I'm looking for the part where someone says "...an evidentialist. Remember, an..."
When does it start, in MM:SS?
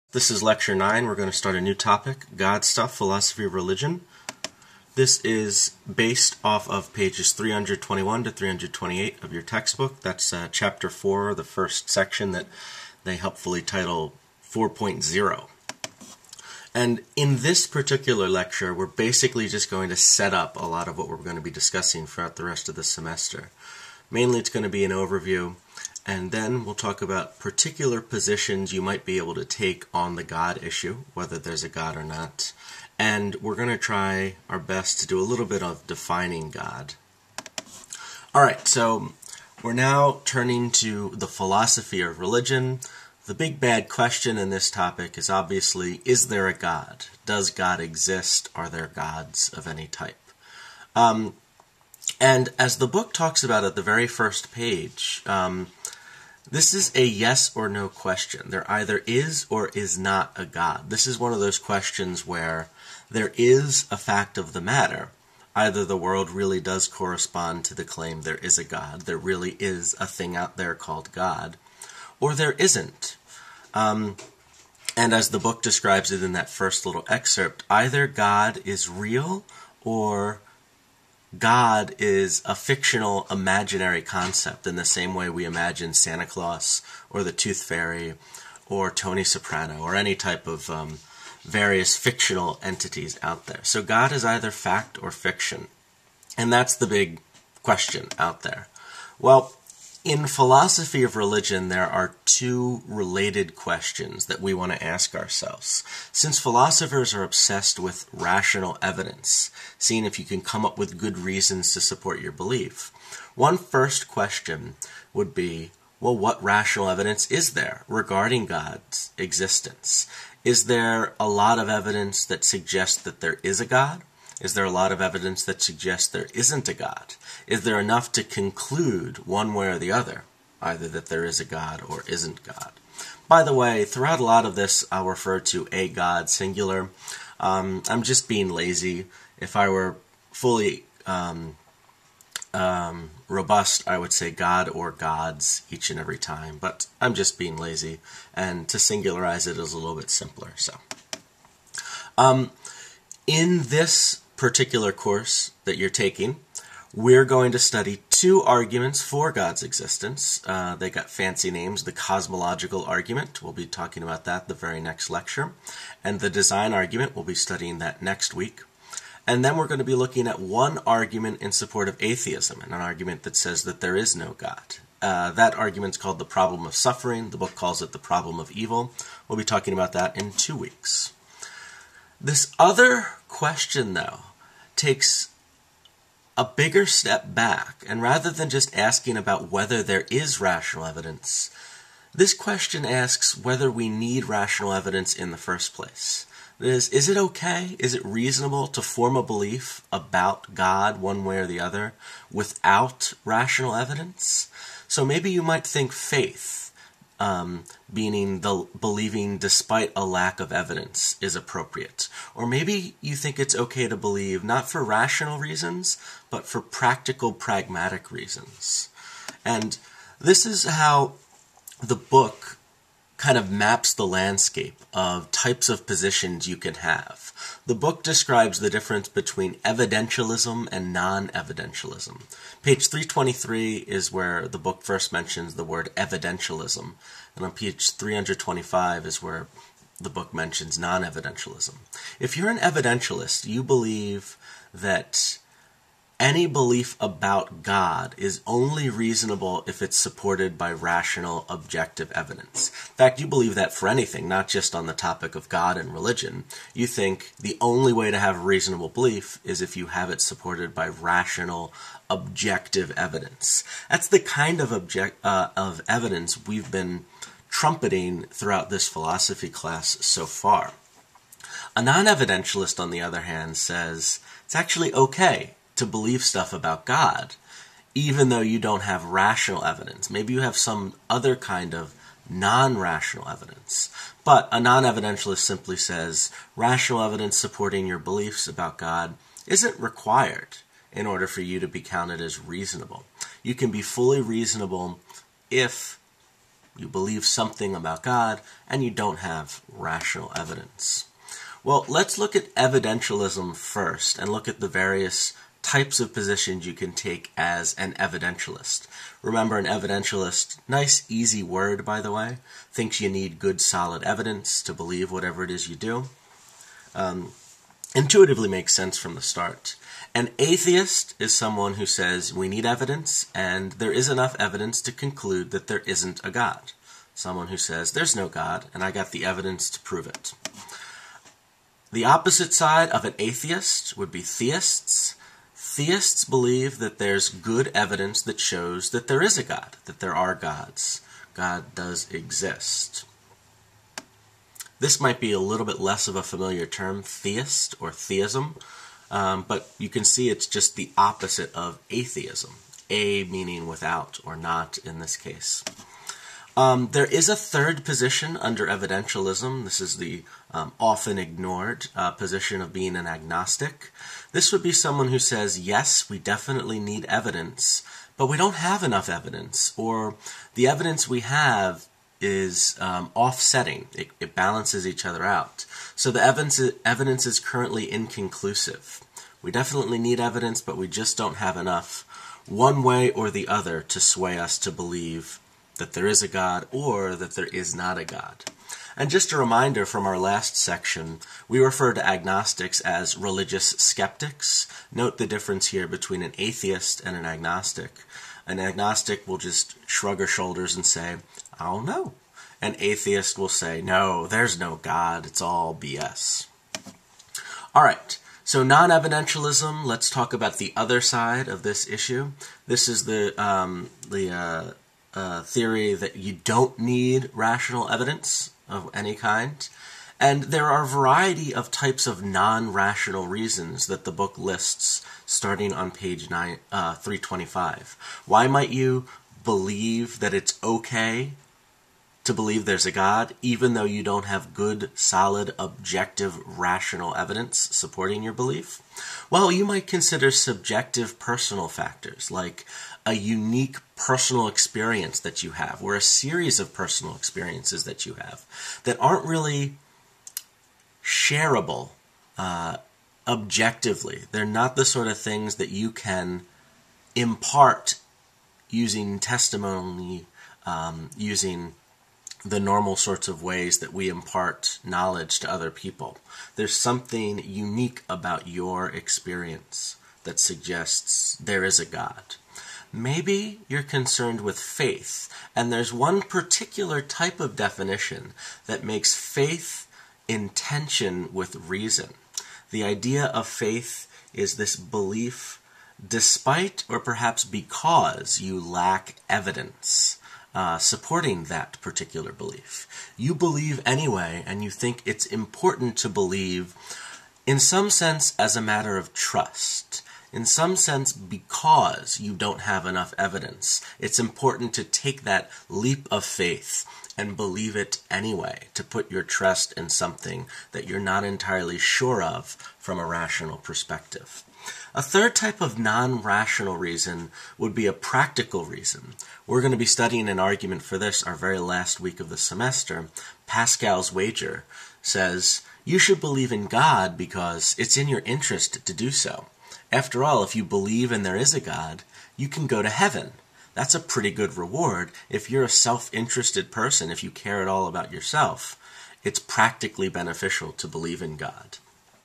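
05:07.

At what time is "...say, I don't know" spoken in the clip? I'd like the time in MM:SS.
06:40.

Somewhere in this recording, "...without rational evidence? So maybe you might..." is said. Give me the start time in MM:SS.
03:22.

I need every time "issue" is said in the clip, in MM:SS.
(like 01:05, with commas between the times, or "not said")
00:30, 06:51.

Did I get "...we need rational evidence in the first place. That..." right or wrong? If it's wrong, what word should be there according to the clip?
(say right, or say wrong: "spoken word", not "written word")
right.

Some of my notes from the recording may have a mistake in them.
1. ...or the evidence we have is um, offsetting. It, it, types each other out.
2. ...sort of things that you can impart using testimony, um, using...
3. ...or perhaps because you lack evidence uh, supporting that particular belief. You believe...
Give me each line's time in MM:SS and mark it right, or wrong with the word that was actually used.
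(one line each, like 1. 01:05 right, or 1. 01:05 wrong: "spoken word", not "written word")
1. 06:09 wrong: "balances", not "types"
2. 07:34 right
3. 08:06 right.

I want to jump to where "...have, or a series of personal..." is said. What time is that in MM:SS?
07:25.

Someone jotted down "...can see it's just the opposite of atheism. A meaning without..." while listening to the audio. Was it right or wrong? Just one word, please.
right.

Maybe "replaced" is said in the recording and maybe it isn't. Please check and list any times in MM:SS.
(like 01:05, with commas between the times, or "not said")
not said.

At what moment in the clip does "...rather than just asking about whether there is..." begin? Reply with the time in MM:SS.
03:08.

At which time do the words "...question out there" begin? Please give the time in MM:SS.
01:37.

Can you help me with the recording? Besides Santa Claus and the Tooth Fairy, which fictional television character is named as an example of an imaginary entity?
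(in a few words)
Tony Soprano.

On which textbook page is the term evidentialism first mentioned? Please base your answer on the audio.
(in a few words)
323.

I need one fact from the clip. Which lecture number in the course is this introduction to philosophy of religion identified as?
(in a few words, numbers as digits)
9.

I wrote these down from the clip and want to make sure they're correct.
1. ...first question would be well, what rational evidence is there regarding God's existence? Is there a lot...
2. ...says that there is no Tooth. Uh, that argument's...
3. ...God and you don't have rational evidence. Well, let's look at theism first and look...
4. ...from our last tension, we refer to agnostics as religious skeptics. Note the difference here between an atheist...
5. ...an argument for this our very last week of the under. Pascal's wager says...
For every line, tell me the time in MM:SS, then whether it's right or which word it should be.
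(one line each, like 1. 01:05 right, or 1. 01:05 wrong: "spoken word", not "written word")
1. 01:53 right
2. 02:53 wrong: "God", not "Tooth"
3. 04:58 wrong: "evidentialism", not "theism"
4. 06:29 wrong: "section", not "tension"
5. 08:40 wrong: "semester", not "under".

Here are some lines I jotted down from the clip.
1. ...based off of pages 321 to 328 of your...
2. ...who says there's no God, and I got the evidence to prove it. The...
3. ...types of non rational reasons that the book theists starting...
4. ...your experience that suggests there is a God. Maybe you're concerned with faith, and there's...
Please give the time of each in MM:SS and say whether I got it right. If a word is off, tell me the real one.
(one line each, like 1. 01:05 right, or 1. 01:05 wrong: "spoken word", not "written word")
1. 00:05 right
2. 05:27 right
3. 07:01 wrong: "lists", not "theists"
4. 07:48 right.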